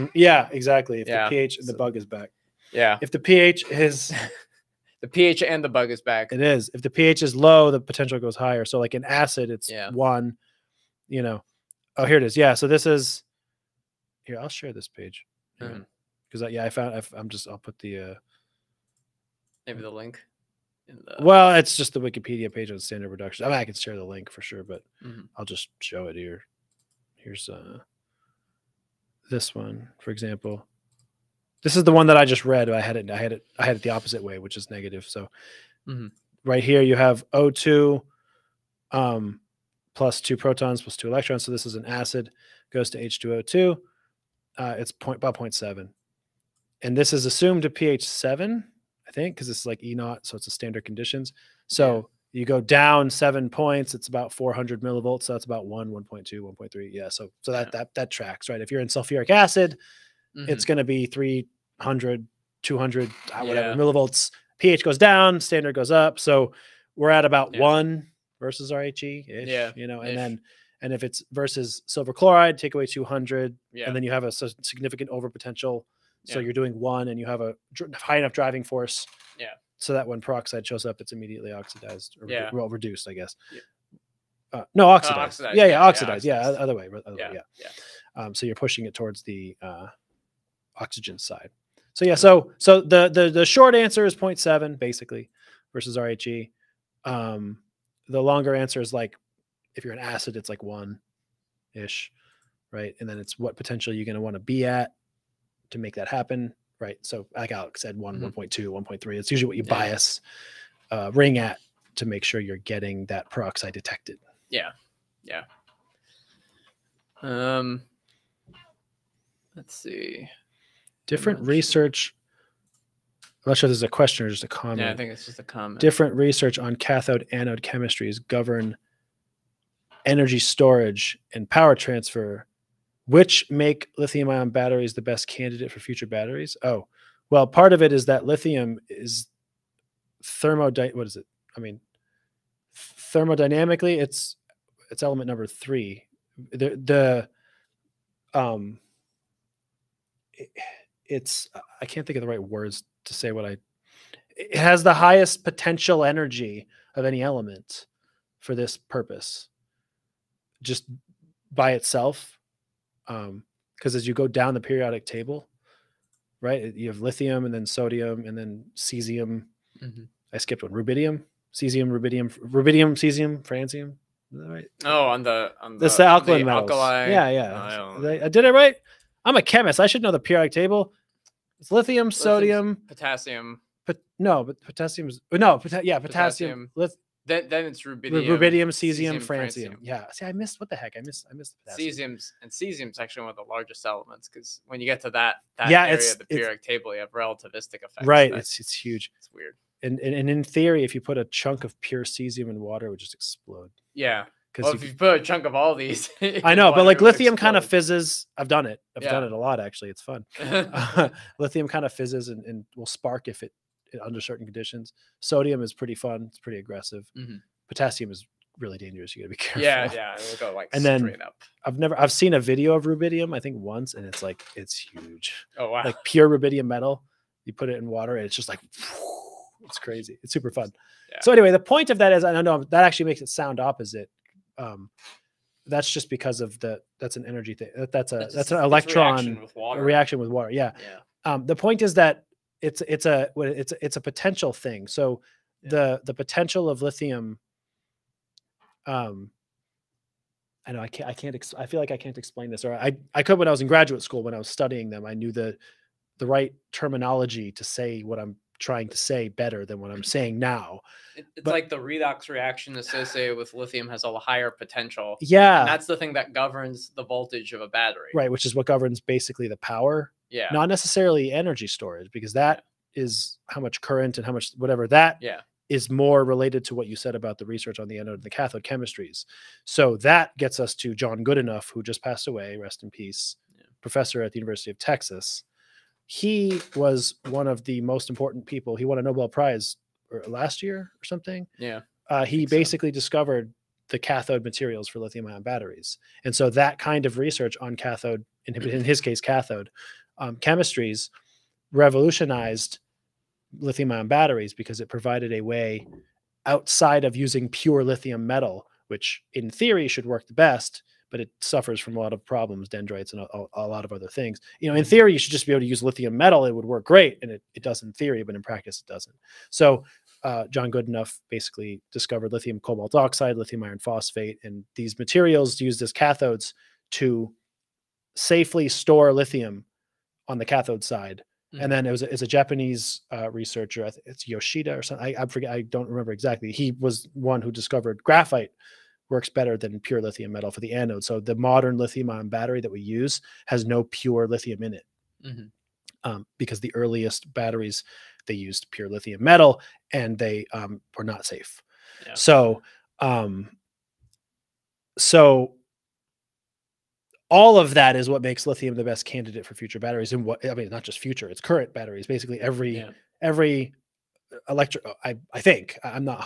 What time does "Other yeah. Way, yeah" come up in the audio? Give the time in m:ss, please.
1:27.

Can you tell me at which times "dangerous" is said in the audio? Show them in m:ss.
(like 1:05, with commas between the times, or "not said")
3:38.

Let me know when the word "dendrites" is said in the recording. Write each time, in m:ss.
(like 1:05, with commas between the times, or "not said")
5:12.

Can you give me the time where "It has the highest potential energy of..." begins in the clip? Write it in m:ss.
2:34.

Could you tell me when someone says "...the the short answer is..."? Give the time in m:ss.
1:33.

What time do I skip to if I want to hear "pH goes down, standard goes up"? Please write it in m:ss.
1:04.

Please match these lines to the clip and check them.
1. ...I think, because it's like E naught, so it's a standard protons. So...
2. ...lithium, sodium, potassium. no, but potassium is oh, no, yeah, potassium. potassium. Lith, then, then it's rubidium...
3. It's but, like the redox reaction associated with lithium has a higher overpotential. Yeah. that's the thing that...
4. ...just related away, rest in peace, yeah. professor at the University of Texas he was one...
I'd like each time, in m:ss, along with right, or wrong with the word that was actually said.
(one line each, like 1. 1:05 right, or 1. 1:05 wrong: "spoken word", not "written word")
1. 0:49 wrong: "conditions", not "protons"
2. 3:01 right
3. 4:21 wrong: "potential", not "overpotential"
4. 4:41 wrong: "passed", not "related".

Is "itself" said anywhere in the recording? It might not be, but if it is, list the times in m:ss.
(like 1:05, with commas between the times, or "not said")
2:41.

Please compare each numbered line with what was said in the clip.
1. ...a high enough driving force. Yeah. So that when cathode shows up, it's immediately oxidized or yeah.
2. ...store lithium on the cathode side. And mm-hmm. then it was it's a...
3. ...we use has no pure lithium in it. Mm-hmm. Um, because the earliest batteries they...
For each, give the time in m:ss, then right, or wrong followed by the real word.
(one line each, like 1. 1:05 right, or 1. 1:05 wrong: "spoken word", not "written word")
1. 1:17 wrong: "peroxide", not "cathode"
2. 5:28 right
3. 5:42 right.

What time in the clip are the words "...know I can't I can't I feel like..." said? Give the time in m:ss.
4:10.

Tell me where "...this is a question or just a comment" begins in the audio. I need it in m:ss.
2:03.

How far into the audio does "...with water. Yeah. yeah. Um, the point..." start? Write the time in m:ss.
4:00.